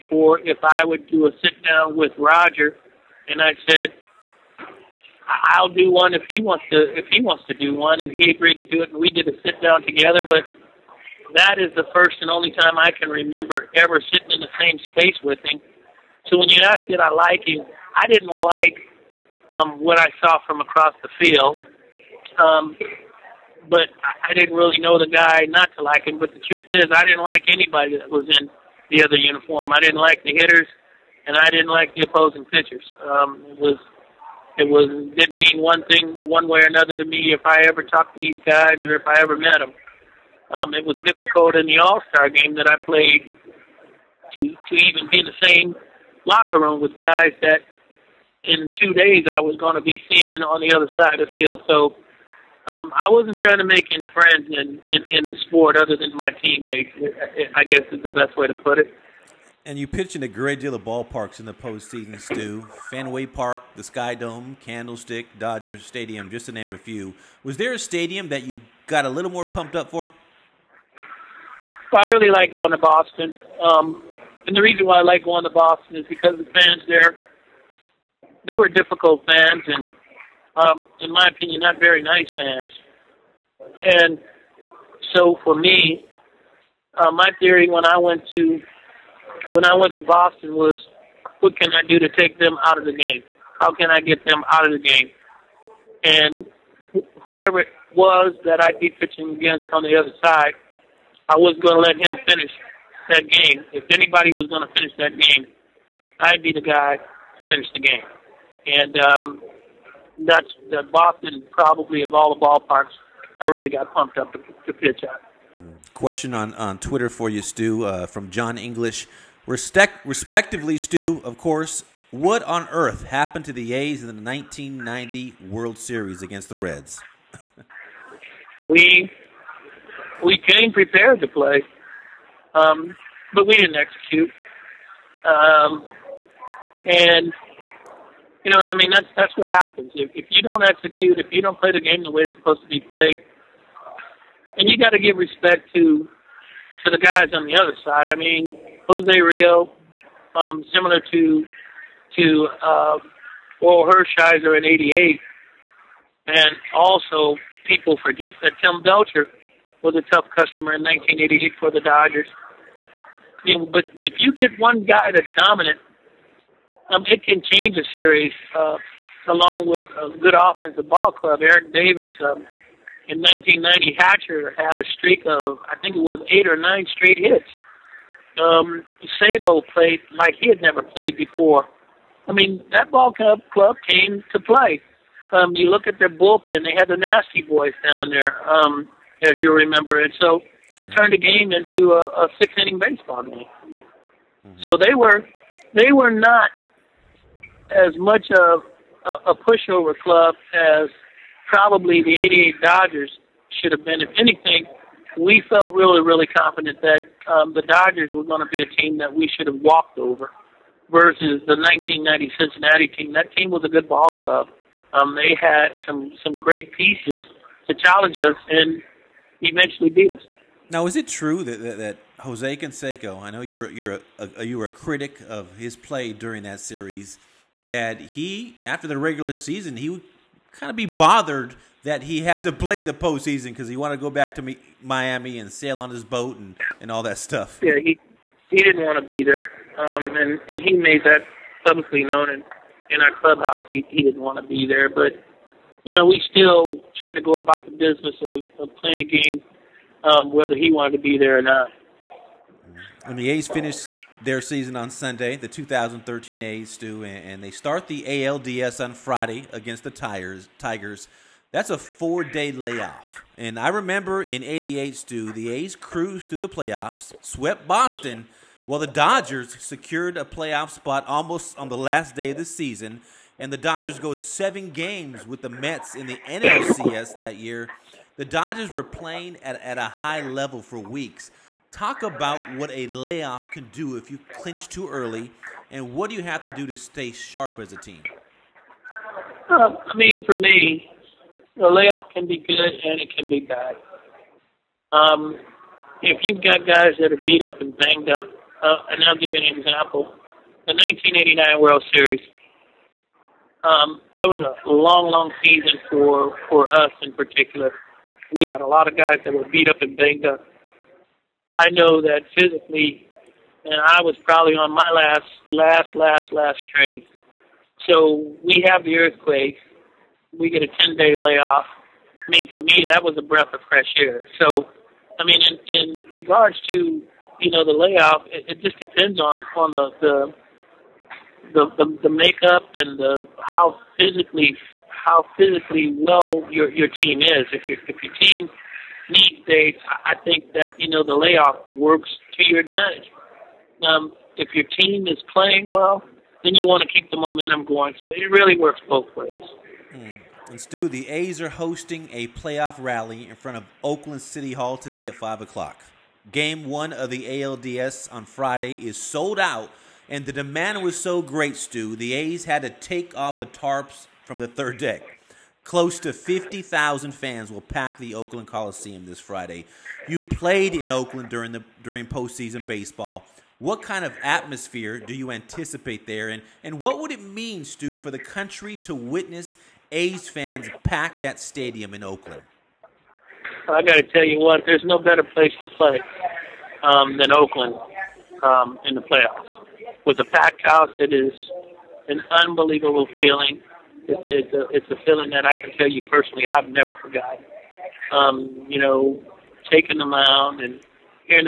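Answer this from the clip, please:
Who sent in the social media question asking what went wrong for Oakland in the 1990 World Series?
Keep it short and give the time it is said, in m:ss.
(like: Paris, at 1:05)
John English, at 1:58.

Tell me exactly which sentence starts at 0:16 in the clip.
So when you asked did I like him, I didn't like um, what I saw from across the field.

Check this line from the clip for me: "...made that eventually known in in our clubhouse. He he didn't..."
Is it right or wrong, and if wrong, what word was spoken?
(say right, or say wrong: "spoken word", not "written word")
wrong: "publicly", not "eventually".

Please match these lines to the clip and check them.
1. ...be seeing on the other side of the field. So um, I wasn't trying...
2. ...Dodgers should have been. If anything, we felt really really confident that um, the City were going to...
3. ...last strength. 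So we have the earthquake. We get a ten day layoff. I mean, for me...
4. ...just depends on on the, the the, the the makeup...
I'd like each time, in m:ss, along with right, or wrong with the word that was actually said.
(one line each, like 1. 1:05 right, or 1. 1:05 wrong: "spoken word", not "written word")
1. 0:49 right
2. 3:22 wrong: "Dodgers", not "City"
3. 5:16 right
4. 5:28 right.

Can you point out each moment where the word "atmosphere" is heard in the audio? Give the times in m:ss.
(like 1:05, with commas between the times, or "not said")
6:14.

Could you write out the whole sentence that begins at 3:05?
Um, you look at their bullpen; they had the nasty boys down there.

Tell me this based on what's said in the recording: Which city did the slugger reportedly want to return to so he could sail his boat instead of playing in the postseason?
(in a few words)
Miami.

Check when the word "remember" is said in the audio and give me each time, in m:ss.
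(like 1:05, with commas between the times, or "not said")
0:13, 3:09, 4:23.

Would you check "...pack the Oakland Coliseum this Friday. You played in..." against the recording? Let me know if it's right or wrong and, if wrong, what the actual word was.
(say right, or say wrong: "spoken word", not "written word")
right.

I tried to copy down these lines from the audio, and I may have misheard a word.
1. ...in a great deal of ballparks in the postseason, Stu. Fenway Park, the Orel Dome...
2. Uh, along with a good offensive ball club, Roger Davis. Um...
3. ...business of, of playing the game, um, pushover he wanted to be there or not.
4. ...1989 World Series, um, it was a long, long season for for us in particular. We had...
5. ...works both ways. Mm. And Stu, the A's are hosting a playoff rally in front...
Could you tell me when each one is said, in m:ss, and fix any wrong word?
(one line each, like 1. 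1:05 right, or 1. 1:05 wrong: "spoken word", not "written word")
1. 1:00 wrong: "Sky", not "Orel"
2. 2:48 wrong: "Eric", not "Roger"
3. 4:07 wrong: "whether", not "pushover"
4. 5:00 right
5. 5:48 right.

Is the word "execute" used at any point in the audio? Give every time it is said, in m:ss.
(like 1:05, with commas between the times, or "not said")
2:13, 2:20.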